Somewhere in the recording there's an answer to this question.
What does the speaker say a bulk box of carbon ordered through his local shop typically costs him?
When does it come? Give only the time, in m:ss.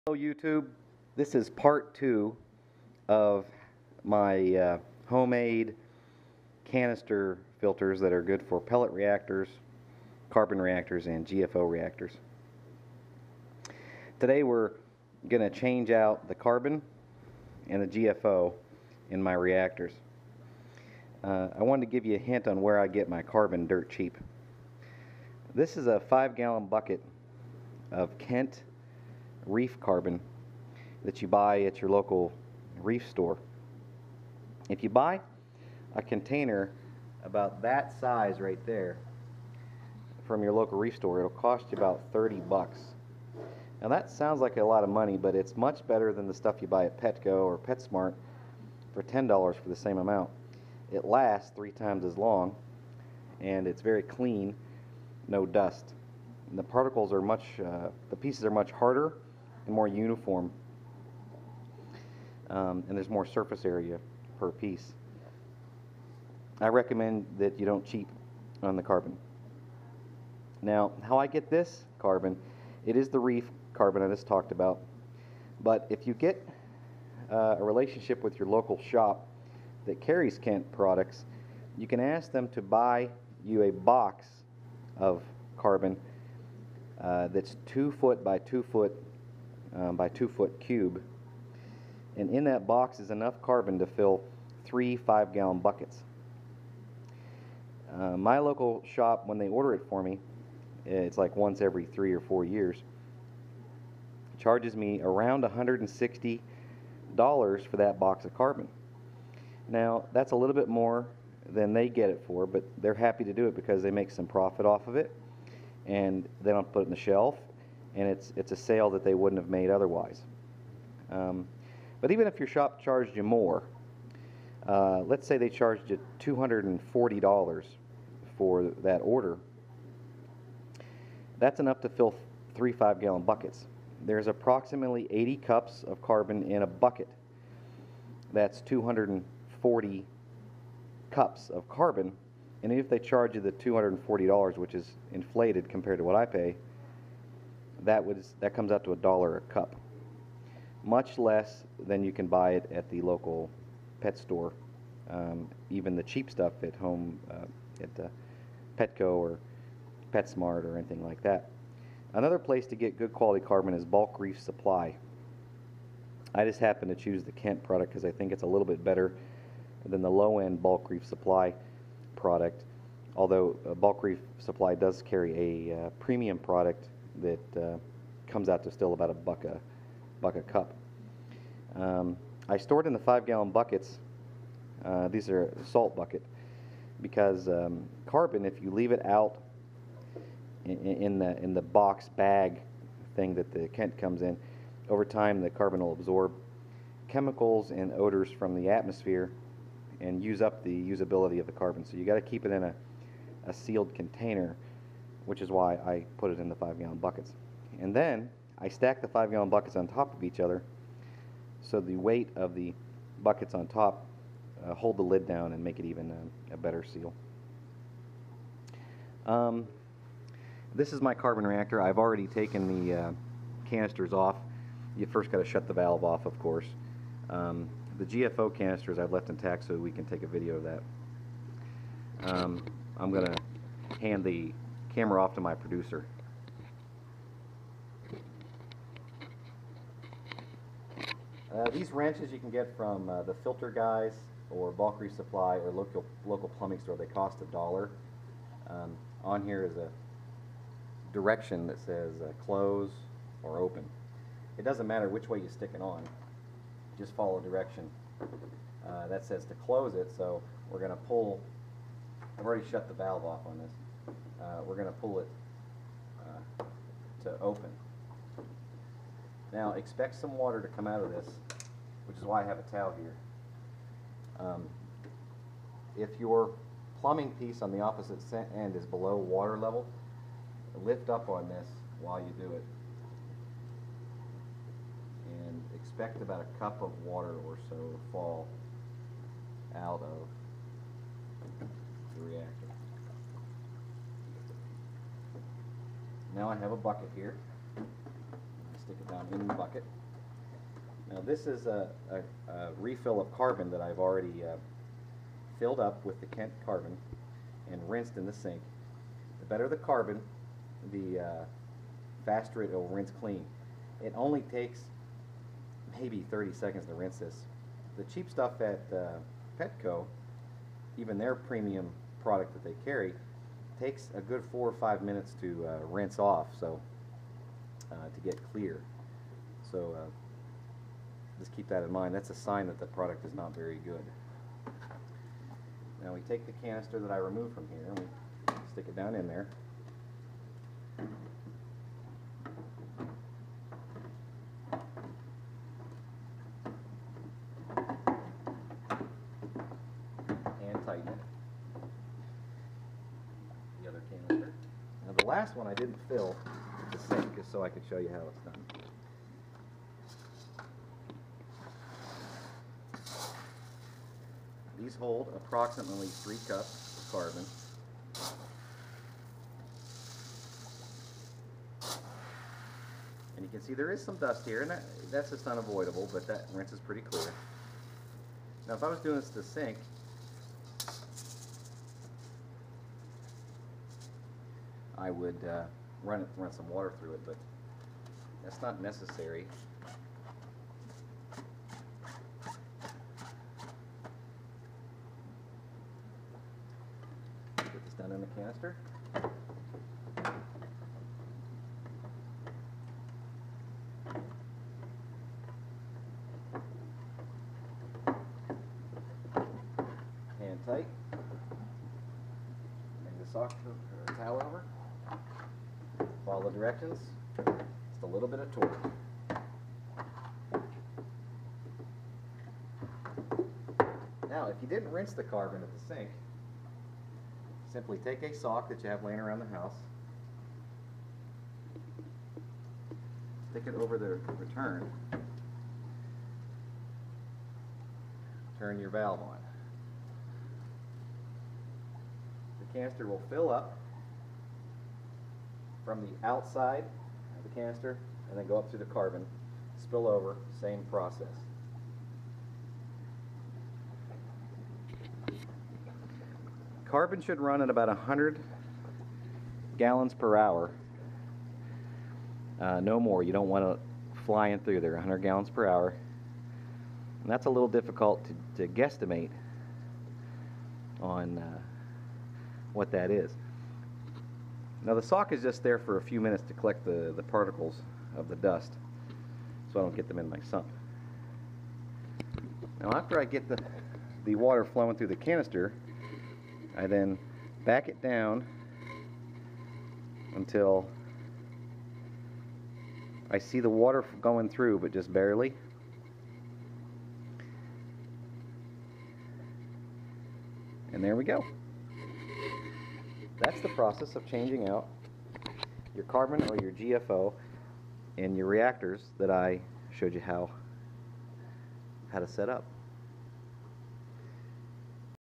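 1:45.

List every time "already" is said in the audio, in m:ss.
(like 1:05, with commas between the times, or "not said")
3:41, 4:22, 5:03.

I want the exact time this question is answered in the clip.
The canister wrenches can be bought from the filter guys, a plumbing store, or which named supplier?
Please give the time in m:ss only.
4:04.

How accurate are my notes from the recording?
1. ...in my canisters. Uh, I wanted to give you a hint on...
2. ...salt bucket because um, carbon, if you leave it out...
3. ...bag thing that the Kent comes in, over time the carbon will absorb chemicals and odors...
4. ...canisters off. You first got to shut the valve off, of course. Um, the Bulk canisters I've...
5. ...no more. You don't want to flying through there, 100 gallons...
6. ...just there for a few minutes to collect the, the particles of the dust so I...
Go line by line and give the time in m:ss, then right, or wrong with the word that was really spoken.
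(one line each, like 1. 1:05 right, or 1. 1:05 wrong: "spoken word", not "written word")
1. 0:19 wrong: "reactors", not "canisters"
2. 3:05 right
3. 3:12 right
4. 3:43 wrong: "GFO", not "Bulk"
5. 7:42 right
6. 7:55 right.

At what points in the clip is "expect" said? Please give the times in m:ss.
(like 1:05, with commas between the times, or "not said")
4:29, 4:45.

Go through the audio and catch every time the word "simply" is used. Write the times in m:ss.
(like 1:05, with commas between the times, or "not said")
7:07.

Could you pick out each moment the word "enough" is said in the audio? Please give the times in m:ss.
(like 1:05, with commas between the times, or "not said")
1:33, 2:11.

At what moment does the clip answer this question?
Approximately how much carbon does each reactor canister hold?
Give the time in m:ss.
6:06.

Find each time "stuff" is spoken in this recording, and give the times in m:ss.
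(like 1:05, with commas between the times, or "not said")
0:46, 2:36, 5:18.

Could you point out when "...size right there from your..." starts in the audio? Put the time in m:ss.
0:37.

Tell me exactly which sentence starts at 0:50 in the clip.
It lasts three times as long, and it's very clean, no dust.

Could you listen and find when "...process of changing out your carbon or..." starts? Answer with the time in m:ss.
8:23.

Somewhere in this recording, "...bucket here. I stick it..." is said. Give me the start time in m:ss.
4:56.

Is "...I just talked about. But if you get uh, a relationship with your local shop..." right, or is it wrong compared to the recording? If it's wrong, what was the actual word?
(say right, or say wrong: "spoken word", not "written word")
right.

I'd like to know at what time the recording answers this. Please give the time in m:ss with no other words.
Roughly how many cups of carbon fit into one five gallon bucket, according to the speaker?
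2:15.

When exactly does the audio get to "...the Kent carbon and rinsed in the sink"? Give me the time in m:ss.
5:06.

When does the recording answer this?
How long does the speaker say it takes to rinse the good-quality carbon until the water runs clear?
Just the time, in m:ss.
5:16.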